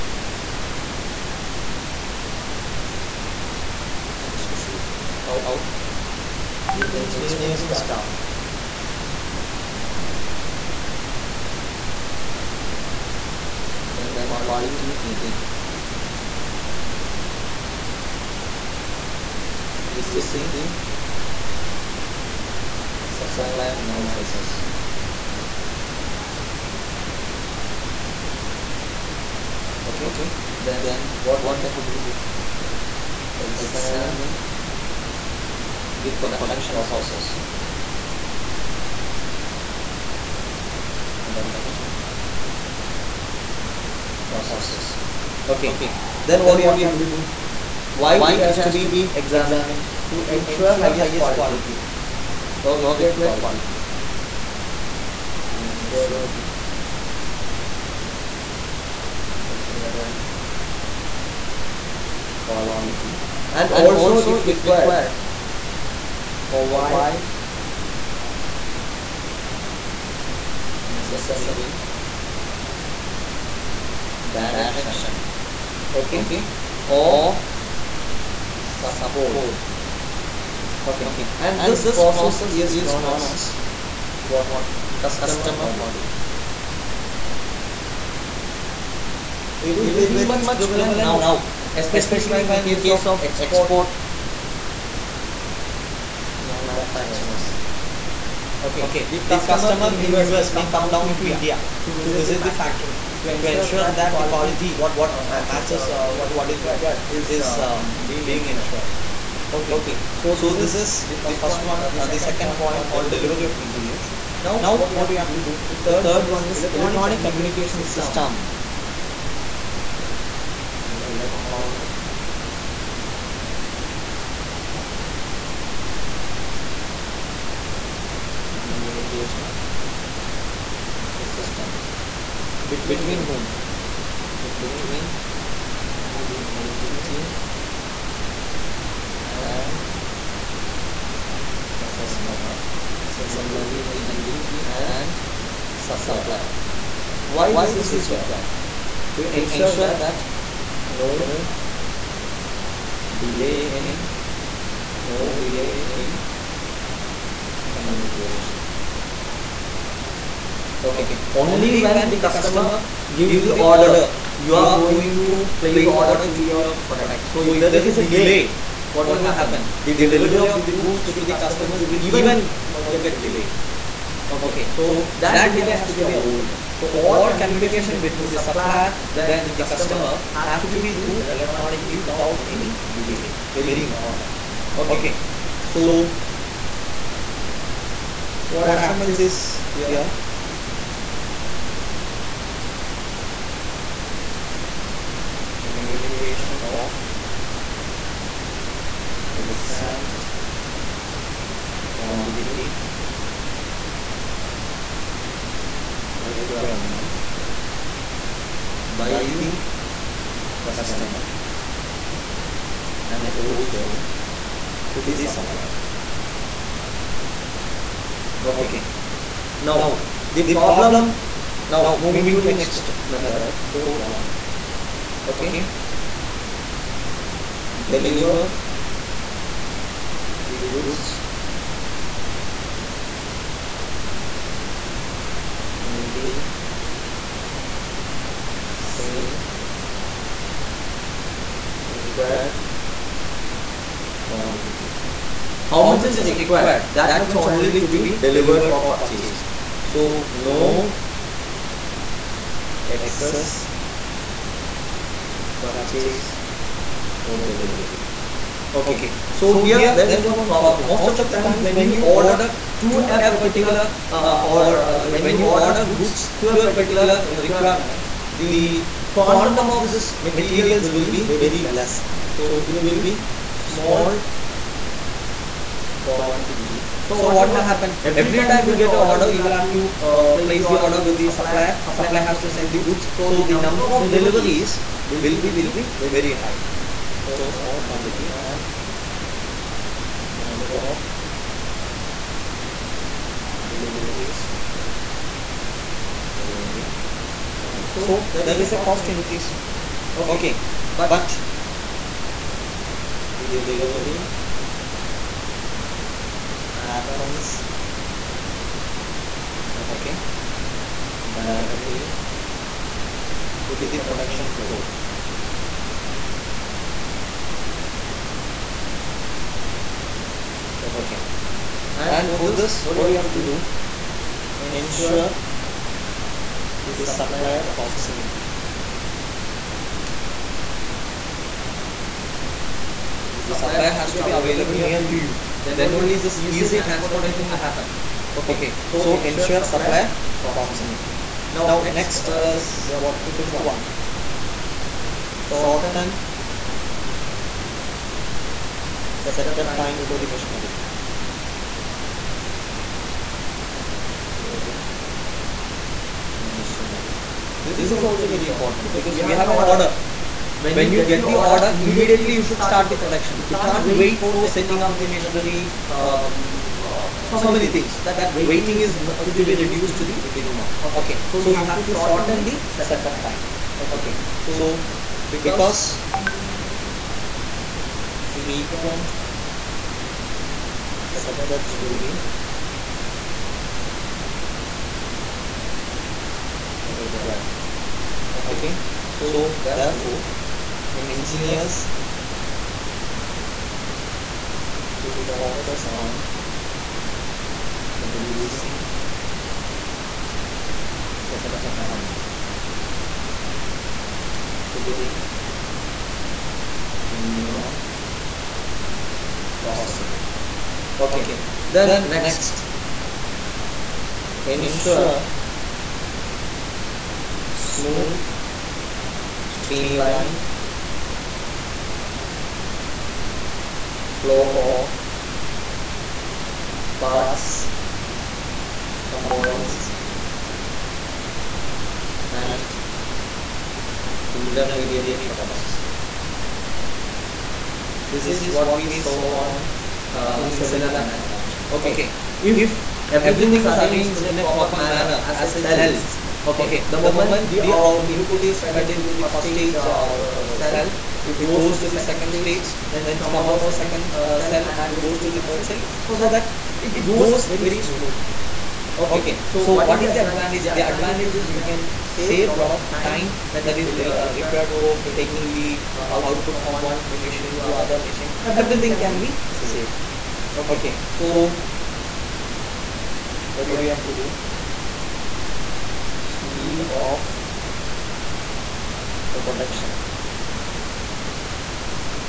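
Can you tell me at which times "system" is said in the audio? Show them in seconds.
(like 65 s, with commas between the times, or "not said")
117 s, 131 s.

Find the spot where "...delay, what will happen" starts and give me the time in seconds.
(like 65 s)
168 s.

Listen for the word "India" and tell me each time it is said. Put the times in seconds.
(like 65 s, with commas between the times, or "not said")
101 s.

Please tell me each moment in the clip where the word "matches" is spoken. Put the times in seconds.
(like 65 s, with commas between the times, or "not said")
105 s.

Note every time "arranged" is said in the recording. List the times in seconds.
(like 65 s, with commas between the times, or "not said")
443 s.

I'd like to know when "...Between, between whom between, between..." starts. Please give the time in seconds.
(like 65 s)
132 s.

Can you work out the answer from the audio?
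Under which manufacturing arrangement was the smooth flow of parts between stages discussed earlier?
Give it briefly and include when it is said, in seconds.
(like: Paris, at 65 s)
cellular manufacturing, at 440 s.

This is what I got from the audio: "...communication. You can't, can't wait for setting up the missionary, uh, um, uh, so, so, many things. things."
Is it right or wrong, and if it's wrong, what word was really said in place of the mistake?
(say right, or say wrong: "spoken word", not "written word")
wrong: "production", not "communication".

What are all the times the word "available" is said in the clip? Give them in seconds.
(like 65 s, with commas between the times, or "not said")
334 s.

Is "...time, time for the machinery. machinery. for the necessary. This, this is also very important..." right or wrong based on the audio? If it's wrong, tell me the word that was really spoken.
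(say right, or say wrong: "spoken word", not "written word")
wrong: "missionary", not "necessary".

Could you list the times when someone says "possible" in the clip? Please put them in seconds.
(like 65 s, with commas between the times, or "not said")
409 s.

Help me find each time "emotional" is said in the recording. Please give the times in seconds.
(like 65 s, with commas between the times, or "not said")
not said.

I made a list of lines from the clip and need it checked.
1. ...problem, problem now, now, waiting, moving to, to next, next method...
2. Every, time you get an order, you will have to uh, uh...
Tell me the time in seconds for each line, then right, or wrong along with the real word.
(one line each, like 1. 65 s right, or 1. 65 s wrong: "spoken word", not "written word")
1. 220 s wrong: "moving", not "waiting"
2. 278 s right.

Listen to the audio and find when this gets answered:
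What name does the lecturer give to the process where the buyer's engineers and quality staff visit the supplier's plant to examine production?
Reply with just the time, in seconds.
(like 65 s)
84 s.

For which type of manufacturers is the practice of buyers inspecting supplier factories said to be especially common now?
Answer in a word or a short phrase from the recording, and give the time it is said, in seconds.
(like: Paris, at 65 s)
export manufacturers, at 93 s.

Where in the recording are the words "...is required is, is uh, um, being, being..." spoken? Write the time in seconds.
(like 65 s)
106 s.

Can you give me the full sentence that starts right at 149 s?
To, to ensure, ensure that, that no, no delay in no, no delay in communication.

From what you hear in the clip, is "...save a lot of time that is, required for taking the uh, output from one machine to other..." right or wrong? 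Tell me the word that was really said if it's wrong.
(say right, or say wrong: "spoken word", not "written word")
right.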